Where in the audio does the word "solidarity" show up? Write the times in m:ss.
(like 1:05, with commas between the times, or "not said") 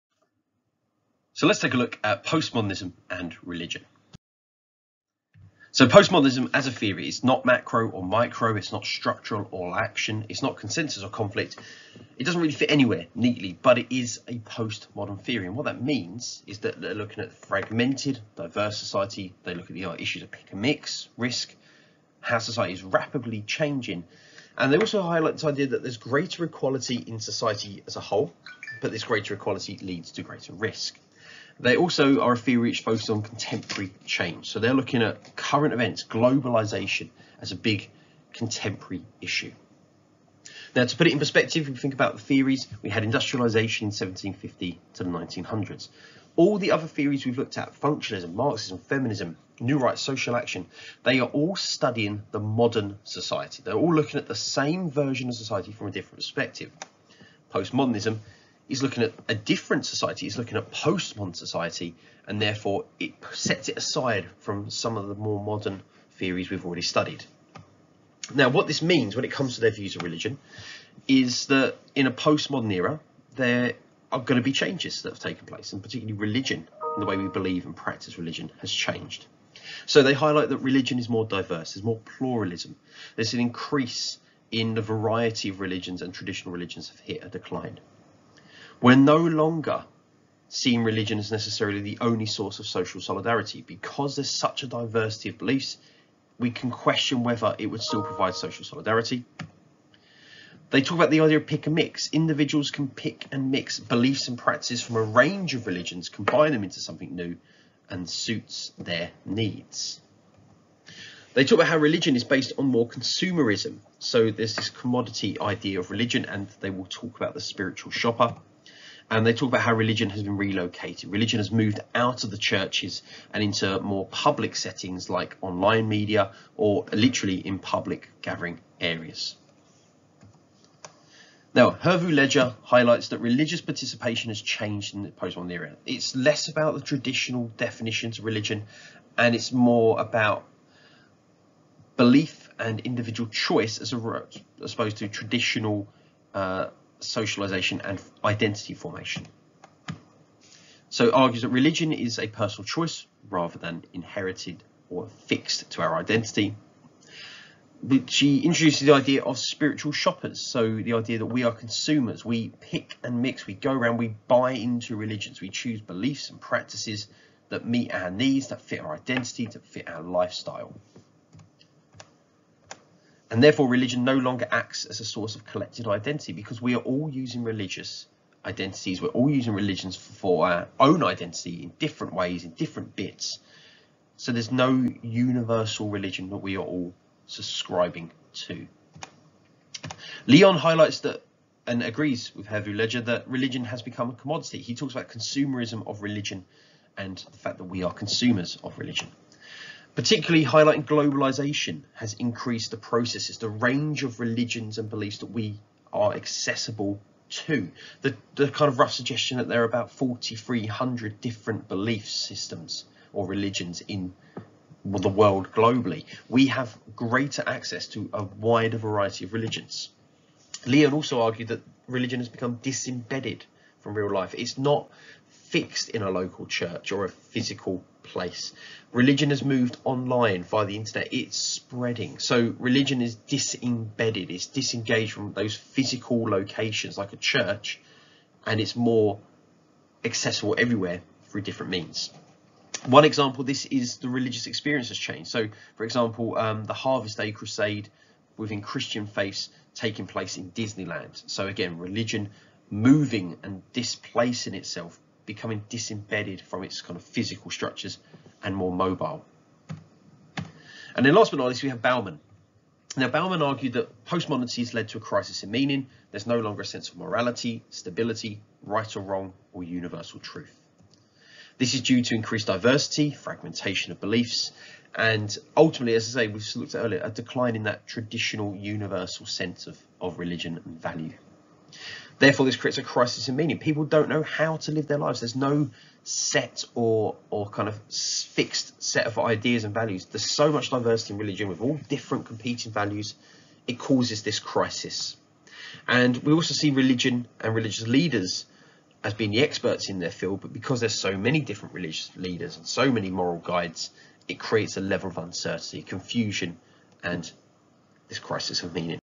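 1:32, 1:38.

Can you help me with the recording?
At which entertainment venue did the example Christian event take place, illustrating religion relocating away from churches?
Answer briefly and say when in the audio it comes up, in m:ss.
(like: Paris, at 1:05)
Disneyland, at 4:10.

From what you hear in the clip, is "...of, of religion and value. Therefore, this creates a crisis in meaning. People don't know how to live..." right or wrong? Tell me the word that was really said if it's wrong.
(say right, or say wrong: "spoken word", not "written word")
right.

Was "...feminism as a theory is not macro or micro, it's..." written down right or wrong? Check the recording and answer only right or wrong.
wrong.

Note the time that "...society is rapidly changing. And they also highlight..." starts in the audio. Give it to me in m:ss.
0:22.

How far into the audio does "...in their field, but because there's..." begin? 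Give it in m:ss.
4:59.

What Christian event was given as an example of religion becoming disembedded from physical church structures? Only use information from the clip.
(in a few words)
Harvest Day Crusade.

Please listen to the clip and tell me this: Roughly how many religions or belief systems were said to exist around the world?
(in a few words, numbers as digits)
4,300.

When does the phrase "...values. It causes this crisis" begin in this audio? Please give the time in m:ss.
4:52.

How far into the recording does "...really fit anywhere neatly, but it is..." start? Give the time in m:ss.
0:12.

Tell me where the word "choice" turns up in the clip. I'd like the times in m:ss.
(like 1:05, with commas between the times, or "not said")
2:23, 2:32.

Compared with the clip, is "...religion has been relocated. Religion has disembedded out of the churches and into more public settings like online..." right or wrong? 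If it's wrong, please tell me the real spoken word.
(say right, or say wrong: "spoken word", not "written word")
wrong: "moved", not "disembedded".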